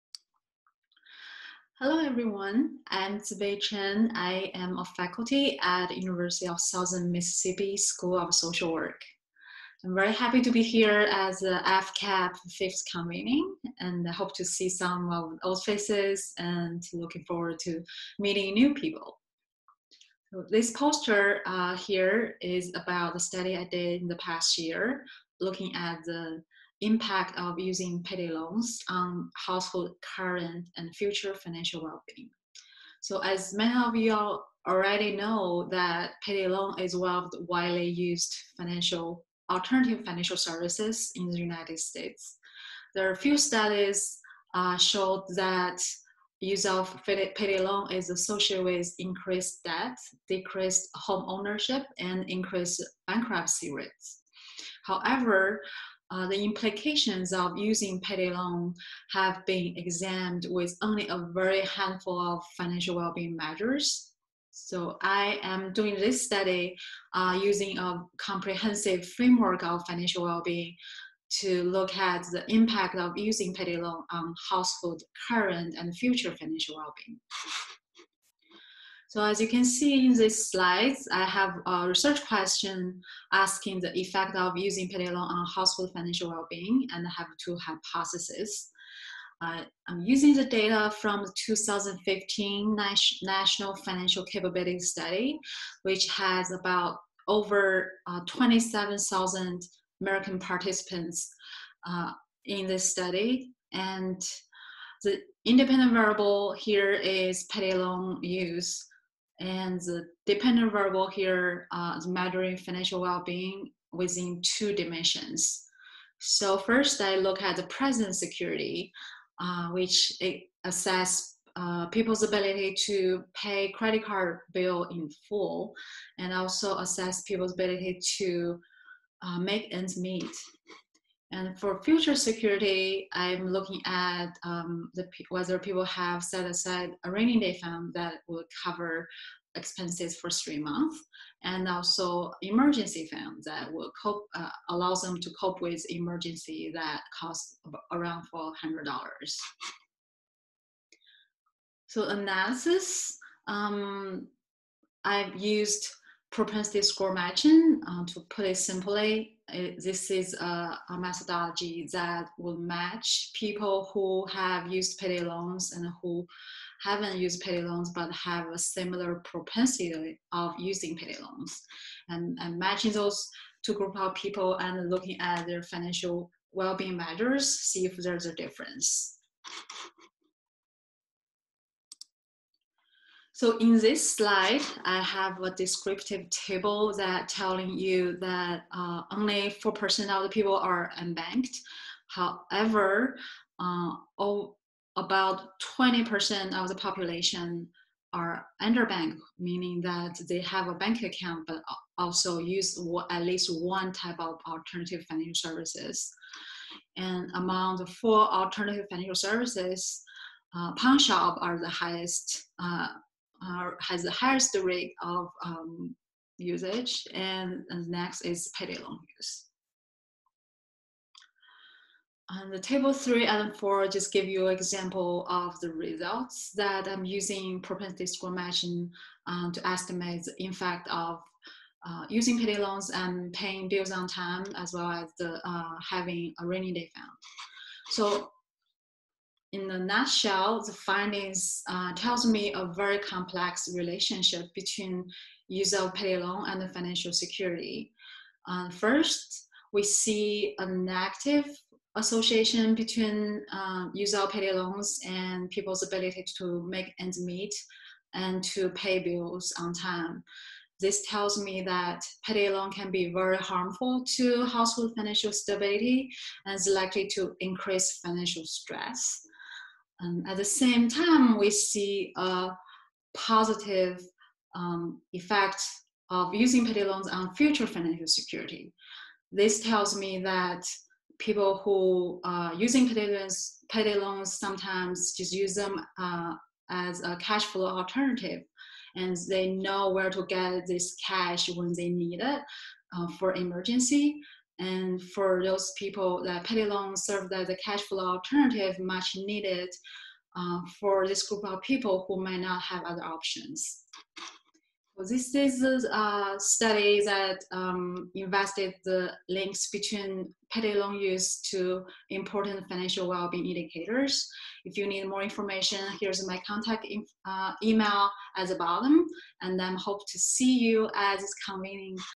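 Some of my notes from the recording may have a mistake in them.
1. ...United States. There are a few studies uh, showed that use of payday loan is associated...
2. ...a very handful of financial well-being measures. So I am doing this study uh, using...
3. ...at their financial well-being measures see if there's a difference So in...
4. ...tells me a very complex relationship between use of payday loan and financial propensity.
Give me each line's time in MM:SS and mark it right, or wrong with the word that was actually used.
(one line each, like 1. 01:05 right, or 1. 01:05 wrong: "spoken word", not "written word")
1. 00:41 right
2. 01:01 right
3. 02:55 right
4. 04:01 wrong: "security", not "propensity".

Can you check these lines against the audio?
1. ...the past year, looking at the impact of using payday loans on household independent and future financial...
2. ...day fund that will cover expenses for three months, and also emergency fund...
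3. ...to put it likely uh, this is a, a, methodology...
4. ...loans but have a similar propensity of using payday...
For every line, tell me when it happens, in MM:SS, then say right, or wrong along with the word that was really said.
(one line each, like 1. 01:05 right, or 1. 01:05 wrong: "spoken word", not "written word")
1. 00:24 wrong: "current", not "independent"
2. 02:17 right
3. 02:38 wrong: "simply", not "likely"
4. 02:47 right.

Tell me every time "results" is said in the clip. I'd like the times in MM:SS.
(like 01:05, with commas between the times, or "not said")
03:45.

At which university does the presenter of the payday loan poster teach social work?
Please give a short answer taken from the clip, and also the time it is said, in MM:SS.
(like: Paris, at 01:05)
University of Southern Mississippi, at 00:05.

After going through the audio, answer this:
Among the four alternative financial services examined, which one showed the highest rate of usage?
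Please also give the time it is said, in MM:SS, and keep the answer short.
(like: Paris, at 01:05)
pawn shop, at 03:30.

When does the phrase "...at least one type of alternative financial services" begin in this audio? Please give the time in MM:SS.
03:23.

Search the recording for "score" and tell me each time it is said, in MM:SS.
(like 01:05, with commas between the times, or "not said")
02:36, 03:48.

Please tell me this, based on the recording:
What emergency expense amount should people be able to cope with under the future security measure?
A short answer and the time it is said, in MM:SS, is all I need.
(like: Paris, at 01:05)
$400, at 02:28.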